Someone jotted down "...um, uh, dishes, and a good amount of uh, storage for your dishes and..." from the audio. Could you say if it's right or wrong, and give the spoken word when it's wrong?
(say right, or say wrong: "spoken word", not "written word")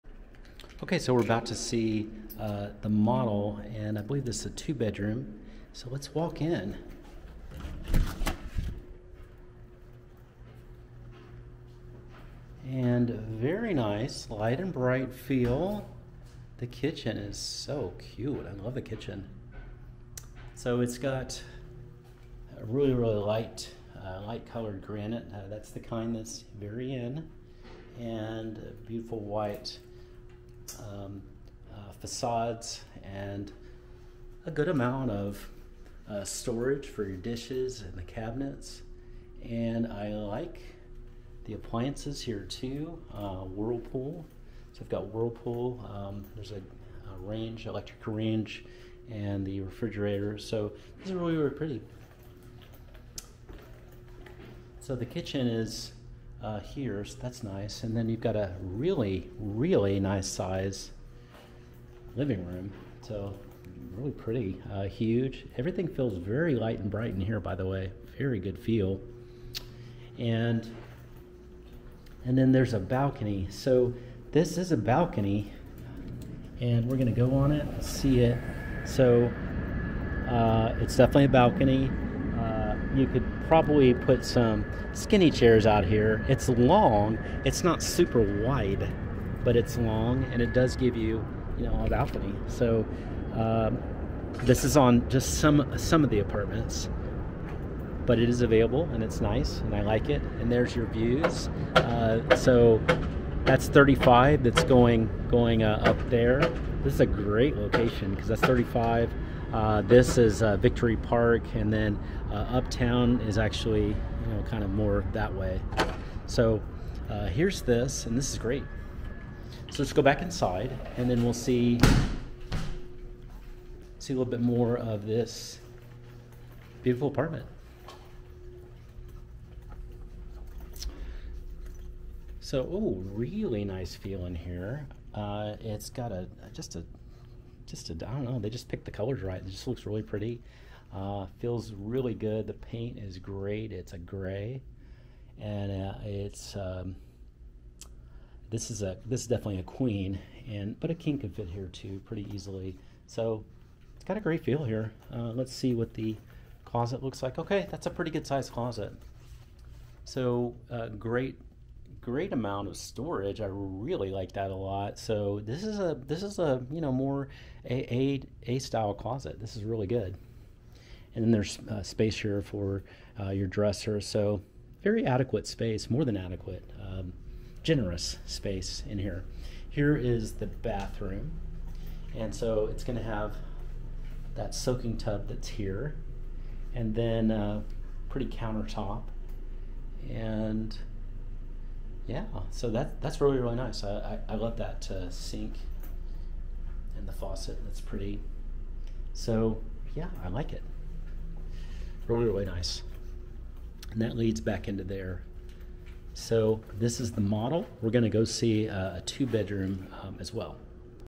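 wrong: "facades", not "dishes".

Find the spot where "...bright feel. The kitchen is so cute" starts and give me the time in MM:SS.
00:14.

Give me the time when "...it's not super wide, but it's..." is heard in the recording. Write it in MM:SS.
01:27.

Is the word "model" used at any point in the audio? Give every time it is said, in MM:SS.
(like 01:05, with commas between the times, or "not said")
00:02, 03:27.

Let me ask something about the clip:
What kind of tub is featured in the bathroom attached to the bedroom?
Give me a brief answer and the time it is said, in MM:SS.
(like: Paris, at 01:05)
Soaking tub, at 03:04.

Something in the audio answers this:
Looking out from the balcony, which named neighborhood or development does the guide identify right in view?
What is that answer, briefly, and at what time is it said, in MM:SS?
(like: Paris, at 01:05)
Victory Park, at 01:50.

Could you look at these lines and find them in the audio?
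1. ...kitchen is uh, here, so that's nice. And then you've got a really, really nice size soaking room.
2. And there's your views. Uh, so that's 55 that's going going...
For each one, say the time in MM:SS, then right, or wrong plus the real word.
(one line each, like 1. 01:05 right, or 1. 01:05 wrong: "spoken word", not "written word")
1. 00:55 wrong: "living", not "soaking"
2. 01:40 wrong: "35", not "55".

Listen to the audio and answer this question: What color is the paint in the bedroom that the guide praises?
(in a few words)
Gray.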